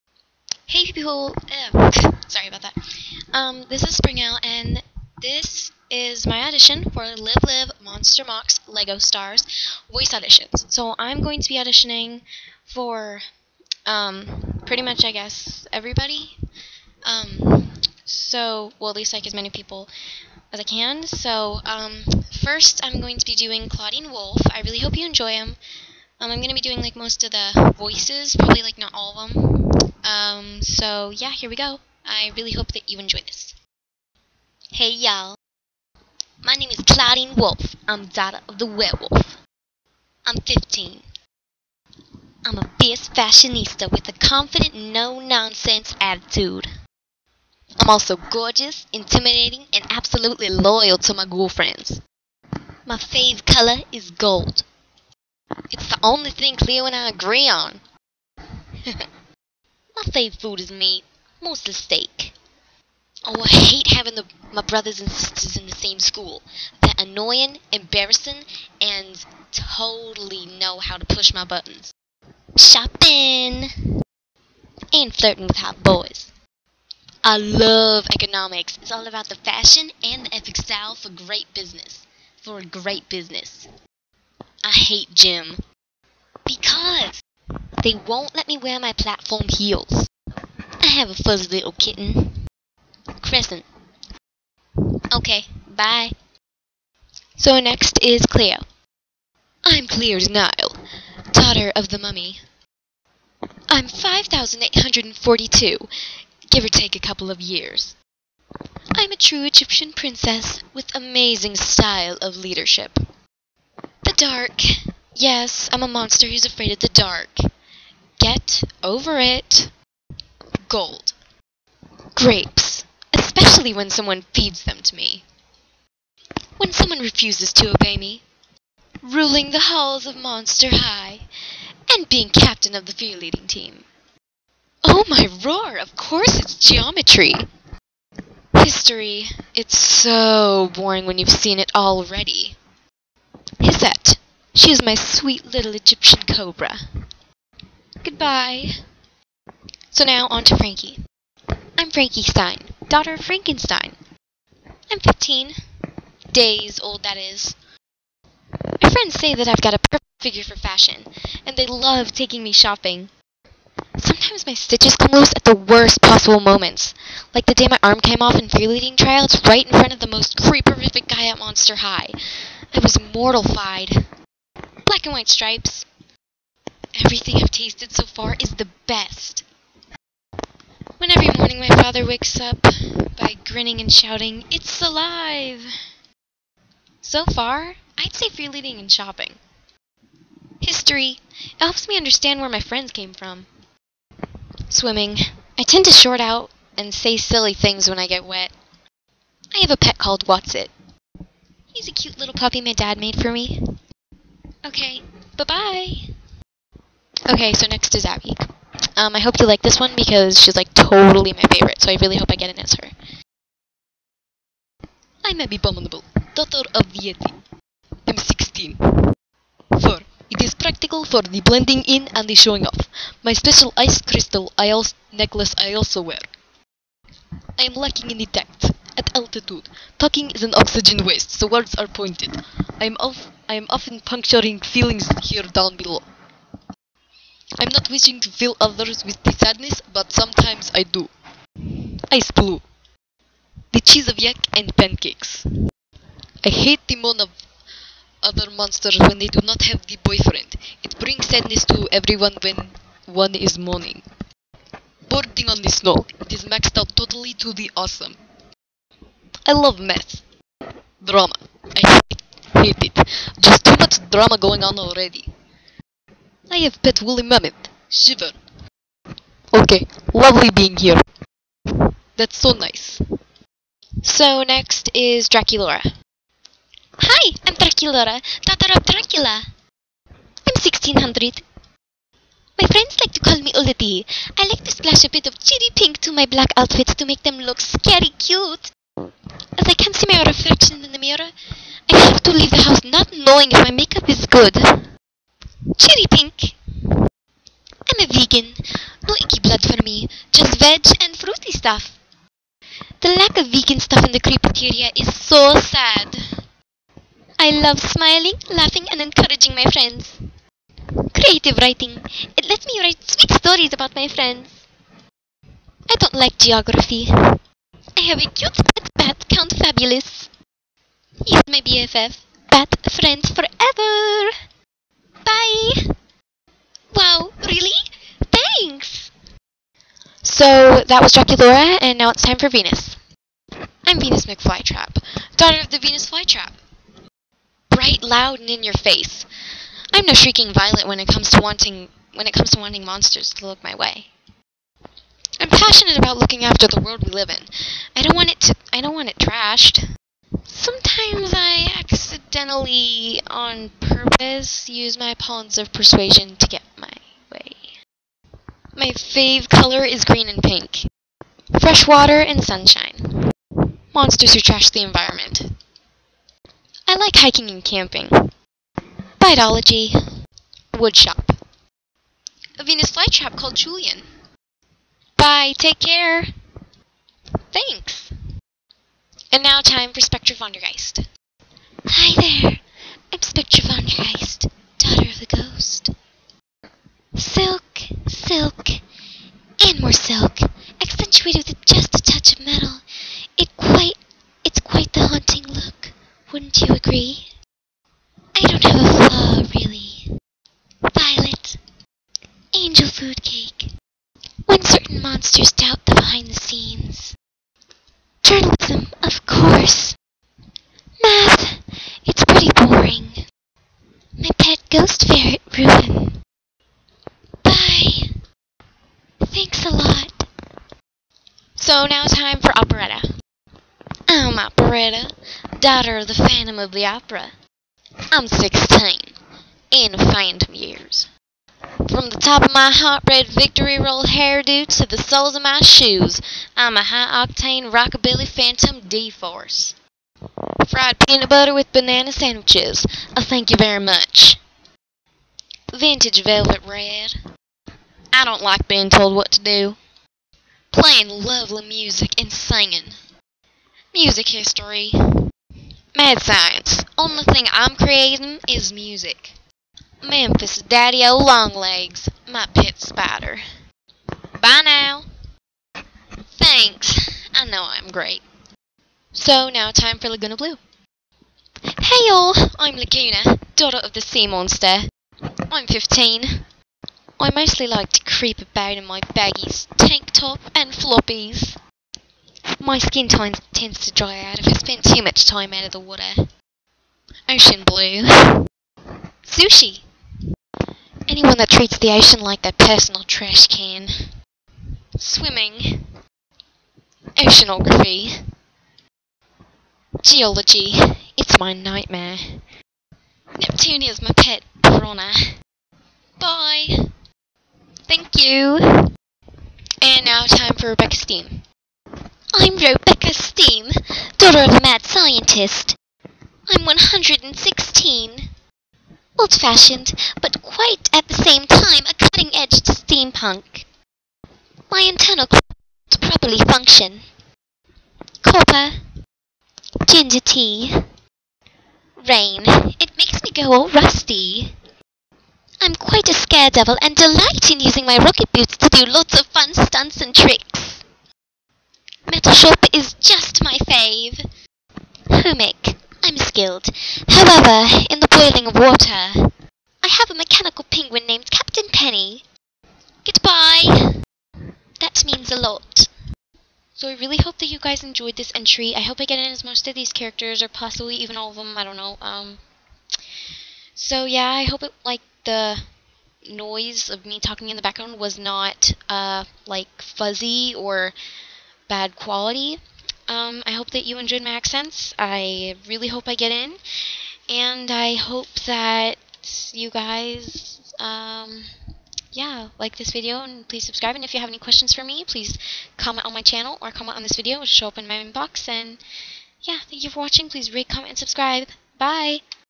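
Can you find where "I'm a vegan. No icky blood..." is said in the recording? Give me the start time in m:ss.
4:56.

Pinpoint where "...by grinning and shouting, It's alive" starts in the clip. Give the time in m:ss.
3:03.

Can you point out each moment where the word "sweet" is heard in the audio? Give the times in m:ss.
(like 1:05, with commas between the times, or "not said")
2:24, 5:13.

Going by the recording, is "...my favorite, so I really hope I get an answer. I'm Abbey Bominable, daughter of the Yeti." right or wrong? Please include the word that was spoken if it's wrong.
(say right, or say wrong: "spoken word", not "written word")
right.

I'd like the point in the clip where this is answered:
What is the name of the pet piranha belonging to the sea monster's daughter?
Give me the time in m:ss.
8:23.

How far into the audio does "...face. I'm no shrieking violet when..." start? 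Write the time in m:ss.
5:38.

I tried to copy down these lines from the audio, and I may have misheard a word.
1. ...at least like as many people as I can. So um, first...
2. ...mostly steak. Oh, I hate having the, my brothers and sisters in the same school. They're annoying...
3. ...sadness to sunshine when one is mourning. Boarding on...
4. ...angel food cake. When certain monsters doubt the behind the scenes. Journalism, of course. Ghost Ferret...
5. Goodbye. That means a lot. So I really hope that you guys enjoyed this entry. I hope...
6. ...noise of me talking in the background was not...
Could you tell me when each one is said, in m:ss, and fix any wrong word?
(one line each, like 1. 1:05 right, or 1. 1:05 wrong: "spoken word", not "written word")
1. 0:18 right
2. 1:01 right
3. 4:11 wrong: "everyone", not "sunshine"
4. 6:42 right
5. 9:13 right
6. 9:26 right.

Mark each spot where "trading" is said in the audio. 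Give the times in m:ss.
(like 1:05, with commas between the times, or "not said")
not said.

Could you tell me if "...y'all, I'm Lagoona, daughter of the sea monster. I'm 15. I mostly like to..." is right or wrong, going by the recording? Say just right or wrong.
right.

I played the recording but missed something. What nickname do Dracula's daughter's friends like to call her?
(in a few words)
Ula D.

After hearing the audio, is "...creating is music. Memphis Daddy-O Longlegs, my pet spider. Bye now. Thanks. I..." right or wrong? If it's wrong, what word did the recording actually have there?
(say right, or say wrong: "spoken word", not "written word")
right.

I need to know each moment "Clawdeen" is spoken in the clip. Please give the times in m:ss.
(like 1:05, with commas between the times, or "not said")
0:23, 0:36.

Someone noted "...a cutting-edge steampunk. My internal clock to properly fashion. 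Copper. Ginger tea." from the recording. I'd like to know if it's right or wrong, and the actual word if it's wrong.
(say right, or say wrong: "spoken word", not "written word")
wrong: "function", not "fashion".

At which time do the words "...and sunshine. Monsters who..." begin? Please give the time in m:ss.
6:02.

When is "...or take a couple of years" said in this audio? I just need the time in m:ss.
1:46.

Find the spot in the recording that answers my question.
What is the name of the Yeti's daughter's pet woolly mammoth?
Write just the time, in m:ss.
4:27.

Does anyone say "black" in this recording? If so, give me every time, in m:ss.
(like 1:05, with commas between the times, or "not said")
2:54, 4:46.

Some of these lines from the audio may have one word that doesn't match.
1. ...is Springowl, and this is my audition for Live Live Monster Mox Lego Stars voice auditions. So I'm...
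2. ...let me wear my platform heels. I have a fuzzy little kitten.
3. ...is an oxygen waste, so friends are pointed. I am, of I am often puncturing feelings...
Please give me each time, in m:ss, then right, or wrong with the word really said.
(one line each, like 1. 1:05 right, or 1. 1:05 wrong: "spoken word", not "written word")
1. 0:03 right
2. 1:28 right
3. 3:50 wrong: "words", not "friends".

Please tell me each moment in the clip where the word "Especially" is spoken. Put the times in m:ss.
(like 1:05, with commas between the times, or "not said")
2:03.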